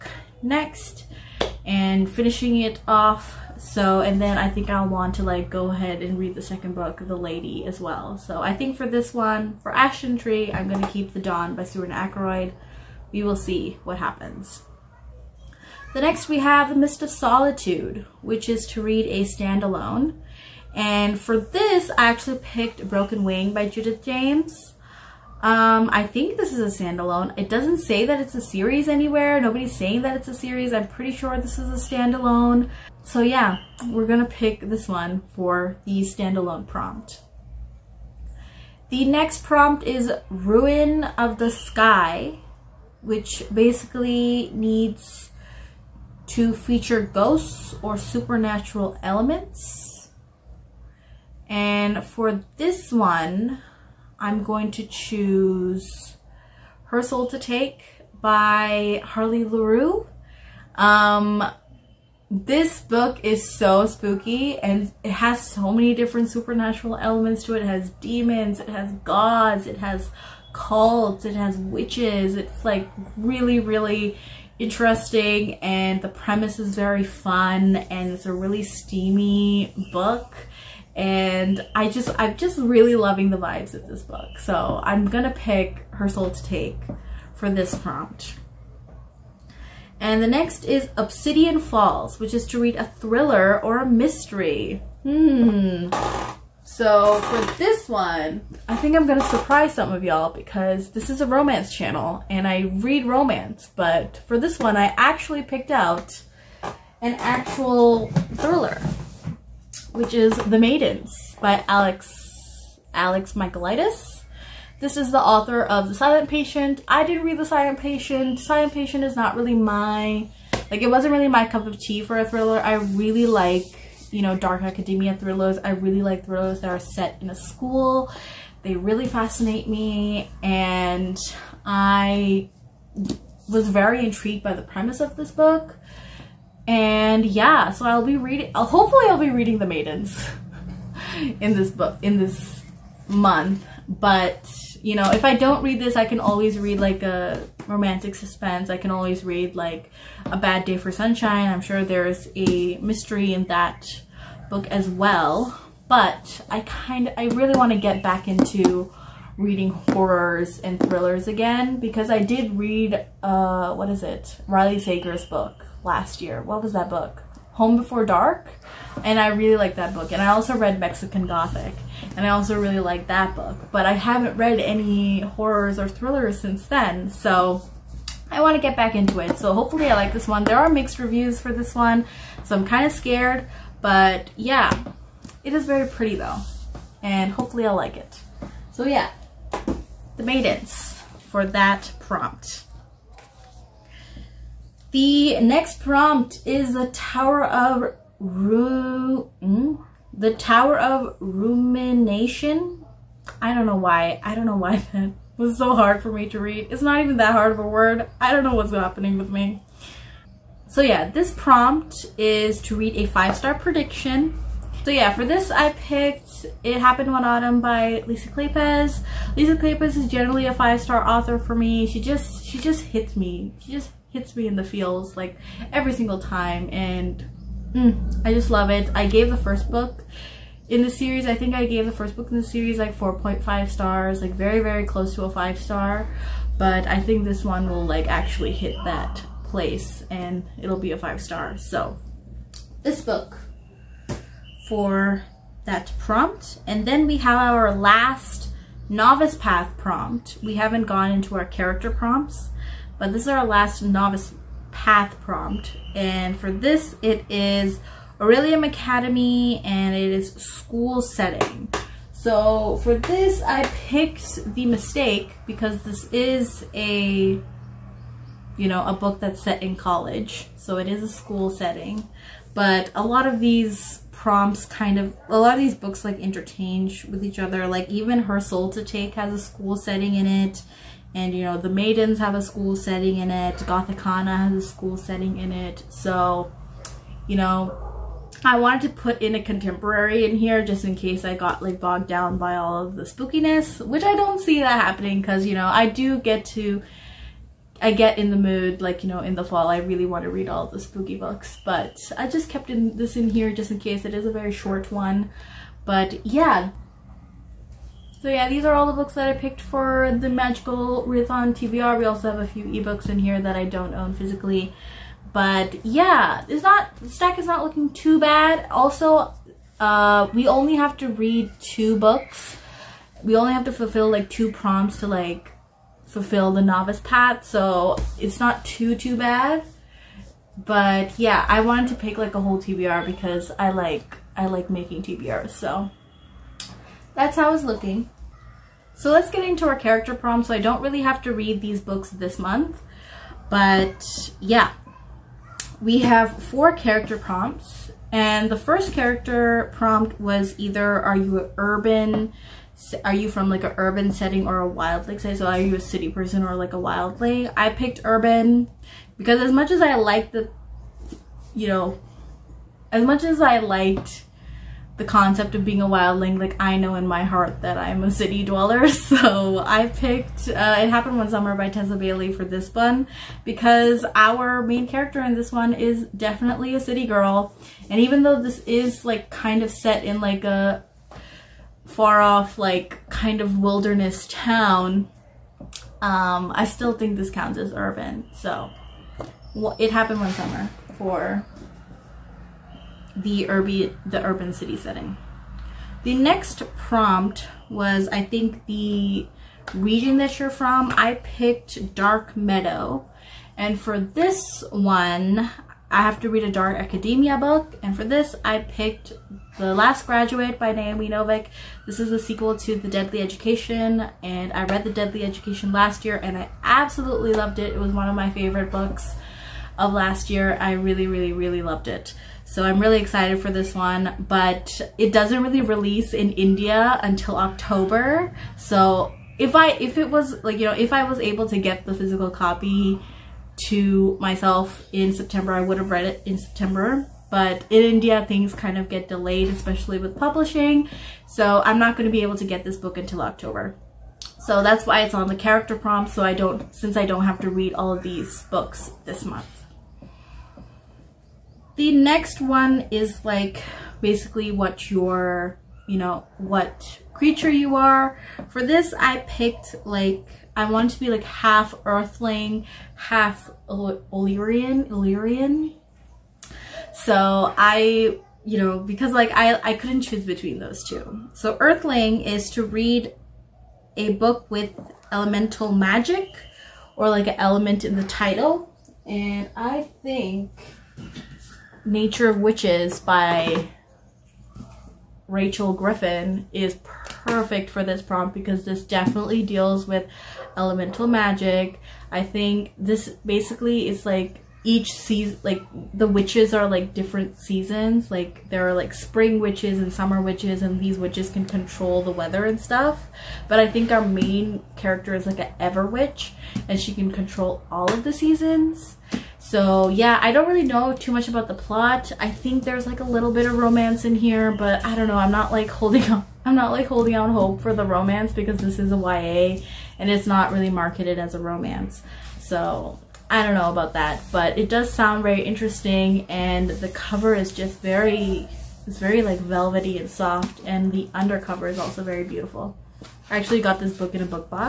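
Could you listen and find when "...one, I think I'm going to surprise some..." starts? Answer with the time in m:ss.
1:37.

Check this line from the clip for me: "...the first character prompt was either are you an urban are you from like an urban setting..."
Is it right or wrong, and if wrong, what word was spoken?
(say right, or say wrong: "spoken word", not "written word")
right.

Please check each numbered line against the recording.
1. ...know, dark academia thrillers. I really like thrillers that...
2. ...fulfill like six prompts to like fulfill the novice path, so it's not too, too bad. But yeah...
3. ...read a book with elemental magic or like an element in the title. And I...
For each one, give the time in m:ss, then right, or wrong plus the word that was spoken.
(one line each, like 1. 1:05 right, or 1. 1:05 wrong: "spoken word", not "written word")
1. 2:04 right
2. 5:23 wrong: "two", not "six"
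3. 7:52 right.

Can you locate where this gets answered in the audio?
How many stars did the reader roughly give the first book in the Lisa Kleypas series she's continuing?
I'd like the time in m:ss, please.
3:52.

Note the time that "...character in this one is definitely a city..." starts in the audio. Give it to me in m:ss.
6:14.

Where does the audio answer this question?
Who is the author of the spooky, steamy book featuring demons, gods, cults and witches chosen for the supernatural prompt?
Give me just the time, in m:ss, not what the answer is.
0:59.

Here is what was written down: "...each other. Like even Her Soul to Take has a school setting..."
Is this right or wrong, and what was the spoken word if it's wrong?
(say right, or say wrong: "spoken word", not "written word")
right.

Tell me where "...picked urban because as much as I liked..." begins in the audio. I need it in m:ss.
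5:57.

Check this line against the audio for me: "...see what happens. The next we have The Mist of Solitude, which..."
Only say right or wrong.
right.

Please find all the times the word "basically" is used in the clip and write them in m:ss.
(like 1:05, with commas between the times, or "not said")
0:43, 7:34, 8:13.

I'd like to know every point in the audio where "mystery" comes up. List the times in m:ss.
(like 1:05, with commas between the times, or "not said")
1:33, 2:32.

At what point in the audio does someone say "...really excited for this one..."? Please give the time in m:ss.
7:02.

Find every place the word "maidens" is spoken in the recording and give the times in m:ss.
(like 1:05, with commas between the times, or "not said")
1:50, 2:19, 3:10, 4:41.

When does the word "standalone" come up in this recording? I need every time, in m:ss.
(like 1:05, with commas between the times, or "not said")
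0:19, 0:26, 0:31, 0:36.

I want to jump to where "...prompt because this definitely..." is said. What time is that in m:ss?
8:08.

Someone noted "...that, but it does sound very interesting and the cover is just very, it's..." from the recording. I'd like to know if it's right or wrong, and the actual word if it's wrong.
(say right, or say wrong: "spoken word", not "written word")
right.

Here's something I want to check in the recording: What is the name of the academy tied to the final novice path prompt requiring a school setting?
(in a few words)
Orilium Academy.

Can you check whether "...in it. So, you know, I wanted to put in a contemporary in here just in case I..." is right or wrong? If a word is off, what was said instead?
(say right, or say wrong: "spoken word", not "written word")
right.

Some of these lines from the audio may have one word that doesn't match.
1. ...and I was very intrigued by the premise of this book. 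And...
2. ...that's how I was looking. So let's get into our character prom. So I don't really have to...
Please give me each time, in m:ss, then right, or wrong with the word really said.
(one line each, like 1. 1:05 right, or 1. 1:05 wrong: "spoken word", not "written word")
1. 2:10 right
2. 5:37 right.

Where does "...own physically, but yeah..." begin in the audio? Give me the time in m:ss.
5:13.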